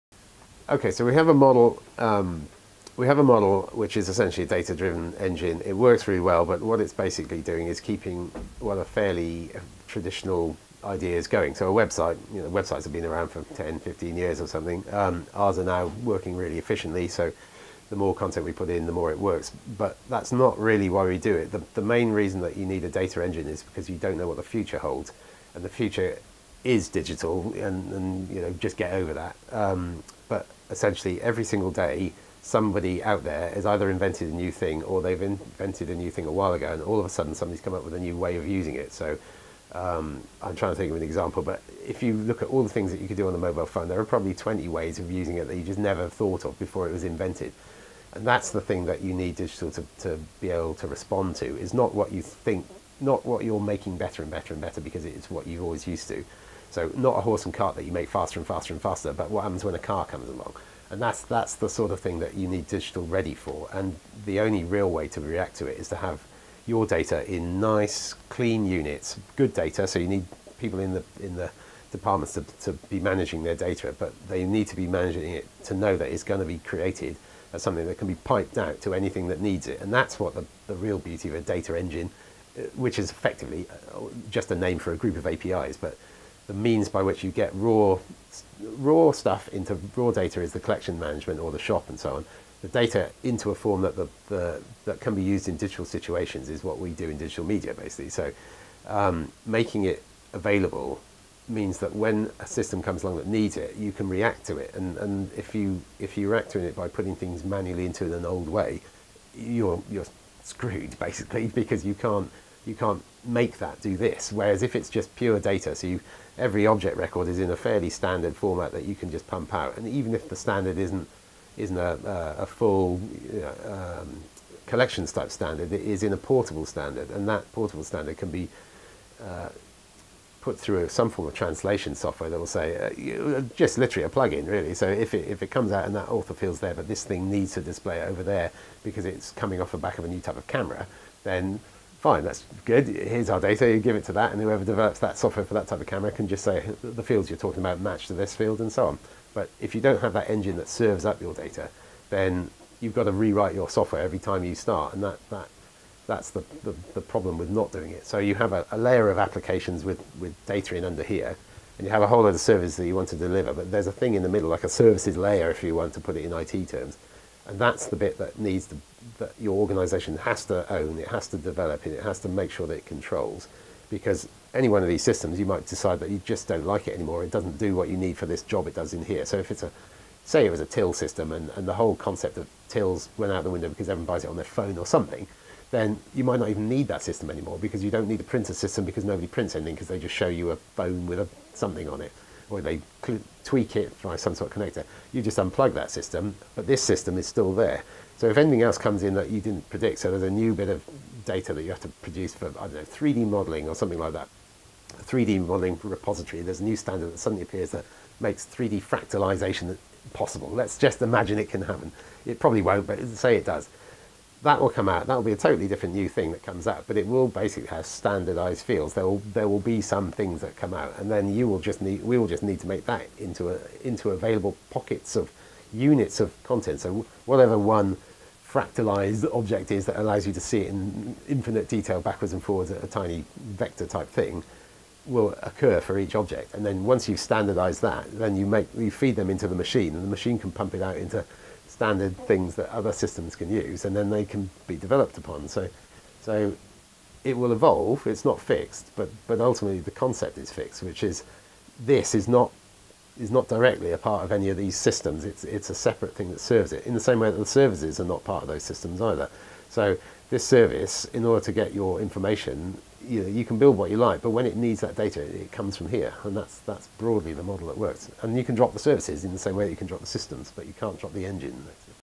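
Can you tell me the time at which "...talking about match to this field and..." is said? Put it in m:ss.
2:27.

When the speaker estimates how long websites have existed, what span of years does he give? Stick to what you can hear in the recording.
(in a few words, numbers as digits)
10-15 years.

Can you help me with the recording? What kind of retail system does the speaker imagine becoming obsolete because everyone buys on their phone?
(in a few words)
till system.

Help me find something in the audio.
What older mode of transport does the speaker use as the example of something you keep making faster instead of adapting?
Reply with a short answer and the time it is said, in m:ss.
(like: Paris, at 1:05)
horse and cart, at 0:57.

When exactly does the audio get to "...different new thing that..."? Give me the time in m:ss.
3:35.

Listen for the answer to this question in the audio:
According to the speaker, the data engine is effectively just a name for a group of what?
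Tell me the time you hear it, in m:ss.
1:25.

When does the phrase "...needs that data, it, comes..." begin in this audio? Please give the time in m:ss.
4:24.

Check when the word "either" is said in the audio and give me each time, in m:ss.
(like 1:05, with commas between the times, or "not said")
0:33, 4:19.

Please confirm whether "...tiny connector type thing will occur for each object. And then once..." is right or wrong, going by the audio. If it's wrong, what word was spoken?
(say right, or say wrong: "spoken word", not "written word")
wrong: "vector", not "connector".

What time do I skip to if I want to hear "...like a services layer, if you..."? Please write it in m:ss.
2:44.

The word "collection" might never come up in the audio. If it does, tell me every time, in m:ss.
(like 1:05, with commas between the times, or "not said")
1:30, 2:04.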